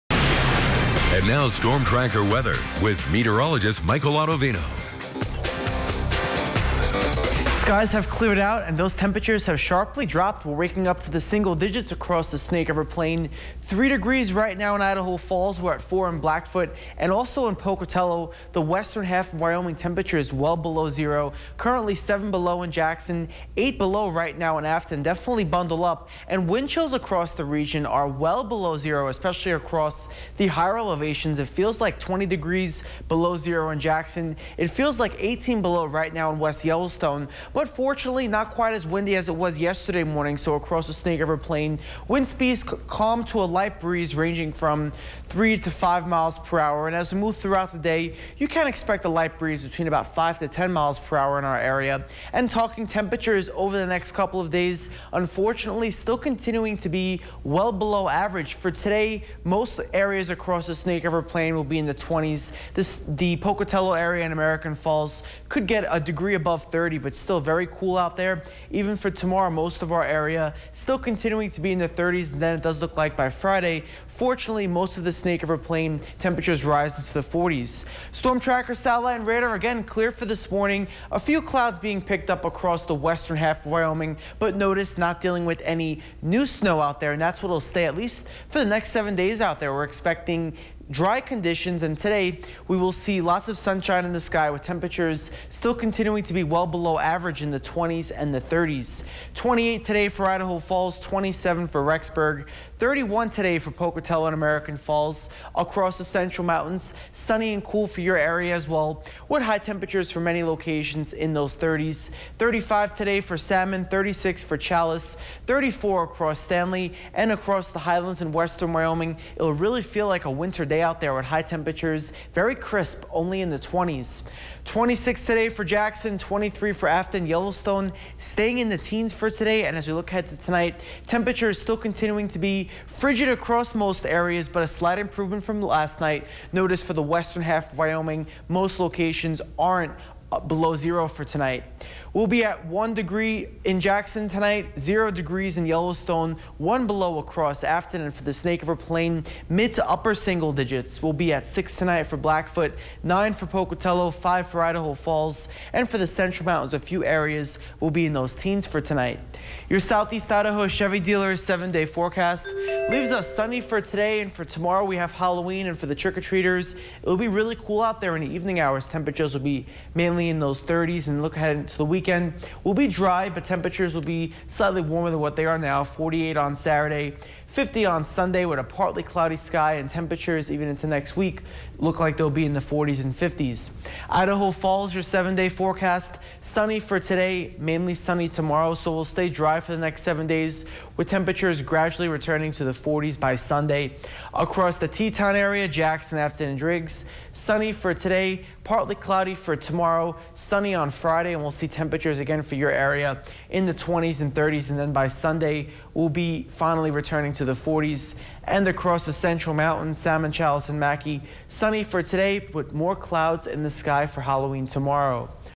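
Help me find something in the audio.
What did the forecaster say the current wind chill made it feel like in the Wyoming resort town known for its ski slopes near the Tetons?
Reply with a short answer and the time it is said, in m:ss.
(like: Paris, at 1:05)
-20 degrees, at 0:31.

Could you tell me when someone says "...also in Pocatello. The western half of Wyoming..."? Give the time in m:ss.
0:17.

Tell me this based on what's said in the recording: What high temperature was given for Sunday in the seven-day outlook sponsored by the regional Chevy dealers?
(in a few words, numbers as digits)
50.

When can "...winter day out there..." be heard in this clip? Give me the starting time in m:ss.
2:00.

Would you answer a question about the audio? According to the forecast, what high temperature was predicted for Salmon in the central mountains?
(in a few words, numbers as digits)
35.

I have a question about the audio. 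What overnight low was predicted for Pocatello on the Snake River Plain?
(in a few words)
9.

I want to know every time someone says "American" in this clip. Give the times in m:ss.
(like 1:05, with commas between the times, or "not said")
1:04, 1:44.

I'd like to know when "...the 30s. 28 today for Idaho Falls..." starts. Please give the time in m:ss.
1:38.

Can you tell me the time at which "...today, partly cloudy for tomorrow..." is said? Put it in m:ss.
3:17.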